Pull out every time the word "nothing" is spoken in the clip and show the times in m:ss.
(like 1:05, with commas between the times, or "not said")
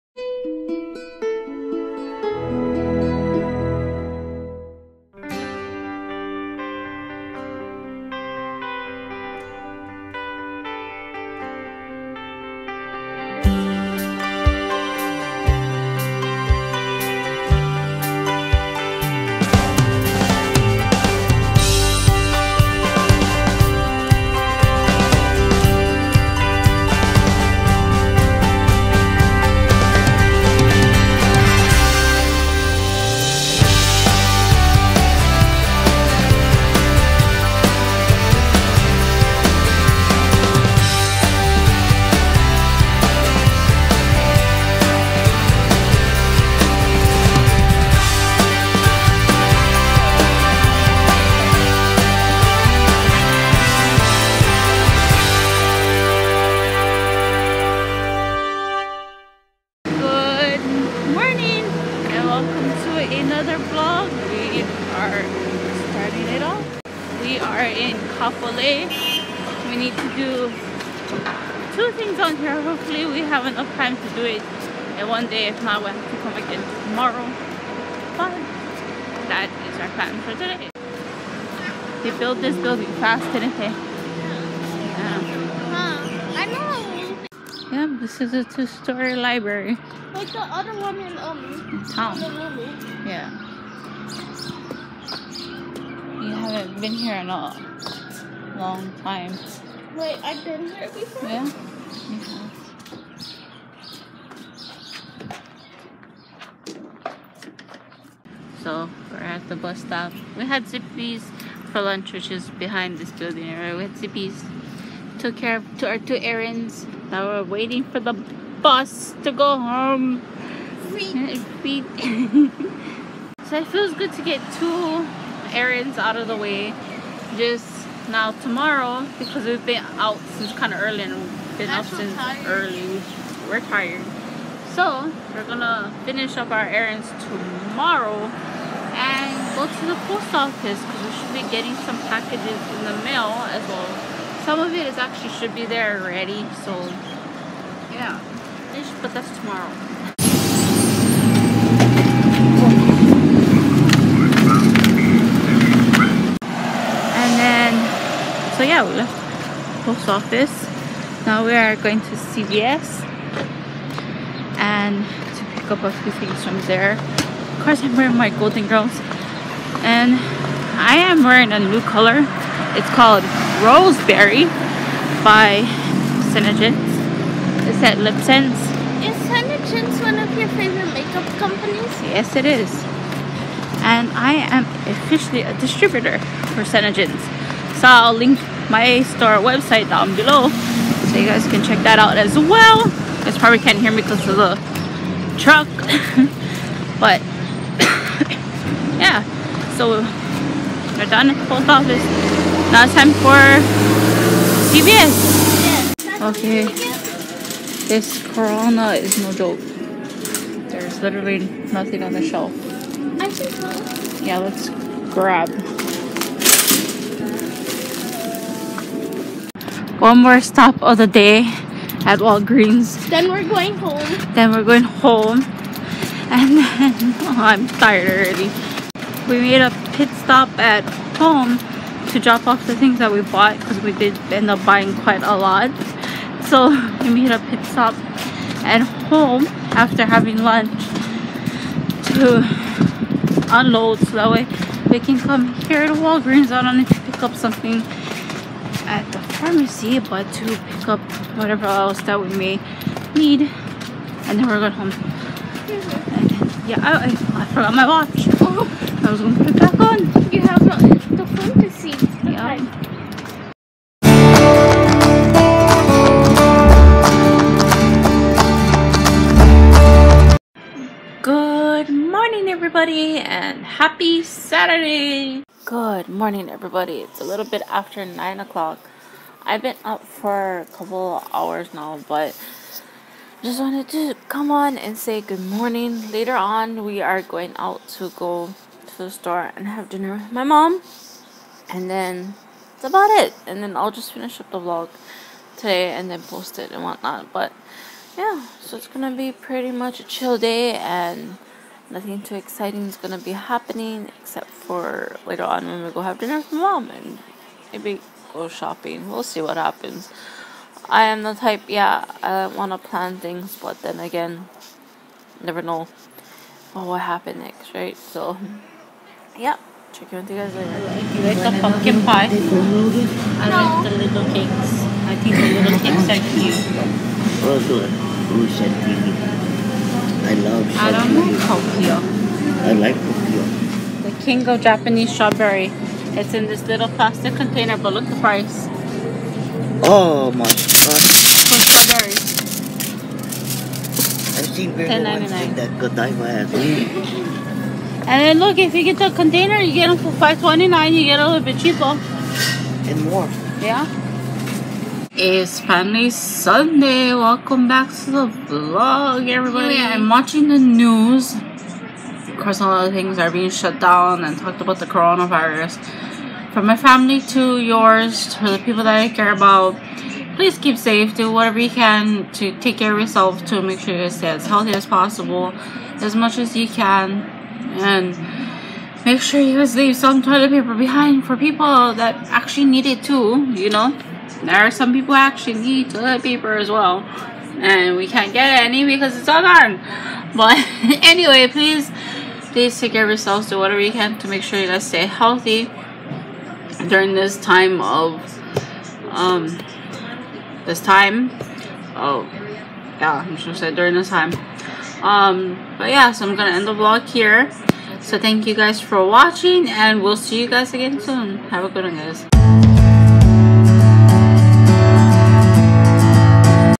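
3:31, 5:01.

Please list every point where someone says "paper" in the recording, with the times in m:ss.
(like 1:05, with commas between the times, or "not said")
6:20, 6:26.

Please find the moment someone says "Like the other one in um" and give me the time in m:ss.
1:30.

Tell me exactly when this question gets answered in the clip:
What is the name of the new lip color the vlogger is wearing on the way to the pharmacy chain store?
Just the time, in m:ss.
2:53.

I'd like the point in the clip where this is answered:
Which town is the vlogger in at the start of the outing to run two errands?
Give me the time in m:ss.
1:08.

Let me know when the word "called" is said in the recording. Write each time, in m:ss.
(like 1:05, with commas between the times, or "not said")
2:52.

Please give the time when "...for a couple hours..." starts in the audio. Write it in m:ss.
4:40.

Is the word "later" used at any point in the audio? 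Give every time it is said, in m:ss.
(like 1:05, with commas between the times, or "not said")
4:46, 5:05, 5:20.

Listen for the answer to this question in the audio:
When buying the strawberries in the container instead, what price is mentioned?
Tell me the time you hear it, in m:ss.
5:50.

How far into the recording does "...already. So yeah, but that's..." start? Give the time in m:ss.
2:26.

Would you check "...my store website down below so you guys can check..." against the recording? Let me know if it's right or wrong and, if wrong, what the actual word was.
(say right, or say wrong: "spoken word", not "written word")
right.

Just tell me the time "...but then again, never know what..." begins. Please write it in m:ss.
5:13.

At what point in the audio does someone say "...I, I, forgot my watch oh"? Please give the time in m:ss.
4:16.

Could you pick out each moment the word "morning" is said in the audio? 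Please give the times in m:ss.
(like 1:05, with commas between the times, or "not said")
4:31, 4:36, 4:45.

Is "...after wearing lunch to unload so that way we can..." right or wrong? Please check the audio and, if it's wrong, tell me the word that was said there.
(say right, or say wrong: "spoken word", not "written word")
wrong: "having", not "wearing".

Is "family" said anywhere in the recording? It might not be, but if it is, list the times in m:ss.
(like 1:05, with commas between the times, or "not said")
6:06.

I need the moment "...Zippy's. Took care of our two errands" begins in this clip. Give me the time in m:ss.
1:53.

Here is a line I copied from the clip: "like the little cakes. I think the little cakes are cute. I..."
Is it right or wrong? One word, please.
right.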